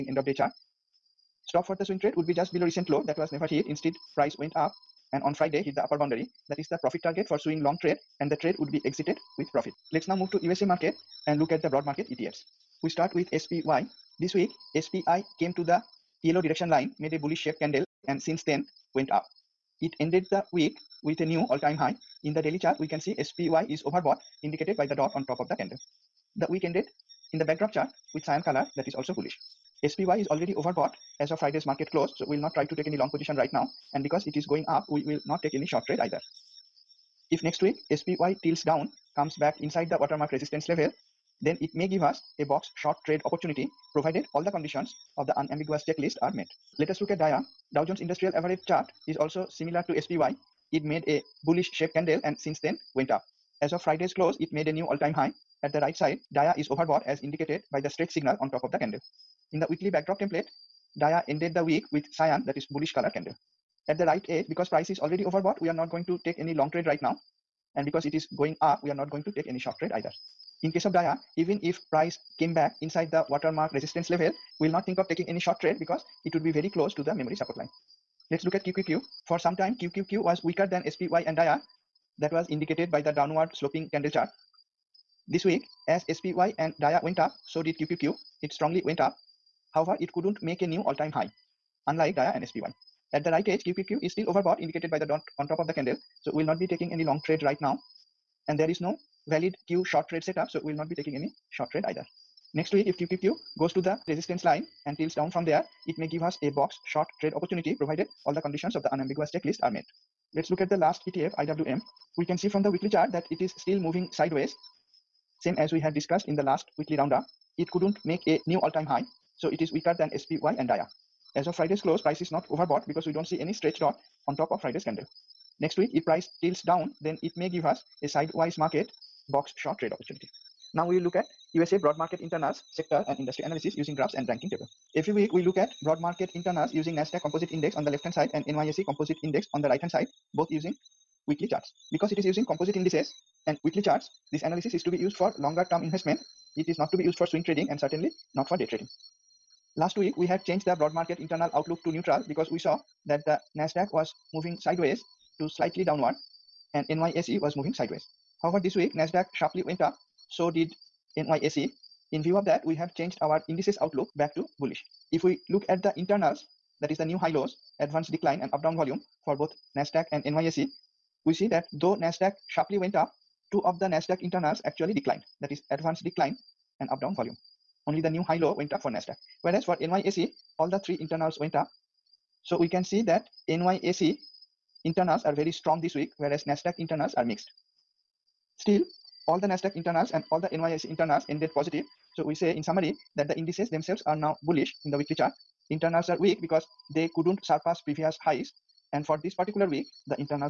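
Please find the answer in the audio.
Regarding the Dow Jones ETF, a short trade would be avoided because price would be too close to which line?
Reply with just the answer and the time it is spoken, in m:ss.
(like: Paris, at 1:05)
memory support line, at 1:17.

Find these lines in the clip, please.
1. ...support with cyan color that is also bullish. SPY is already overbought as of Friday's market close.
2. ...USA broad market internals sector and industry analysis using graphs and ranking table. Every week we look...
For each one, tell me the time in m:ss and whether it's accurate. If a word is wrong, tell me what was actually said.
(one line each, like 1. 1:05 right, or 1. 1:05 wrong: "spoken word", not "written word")
1. 0:27 wrong: "chart", not "support"
2. 2:11 right.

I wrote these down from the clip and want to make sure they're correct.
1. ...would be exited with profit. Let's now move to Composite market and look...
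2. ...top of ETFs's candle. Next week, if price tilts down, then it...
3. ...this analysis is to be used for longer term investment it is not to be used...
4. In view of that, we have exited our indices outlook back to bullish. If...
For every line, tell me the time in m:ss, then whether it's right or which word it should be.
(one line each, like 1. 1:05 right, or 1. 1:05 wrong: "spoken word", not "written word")
1. 0:08 wrong: "USA", not "Composite"
2. 2:04 wrong: "Friday", not "ETFs"
3. 2:24 right
4. 2:42 wrong: "changed", not "exited".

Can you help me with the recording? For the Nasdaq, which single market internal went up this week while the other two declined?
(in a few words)
new high low.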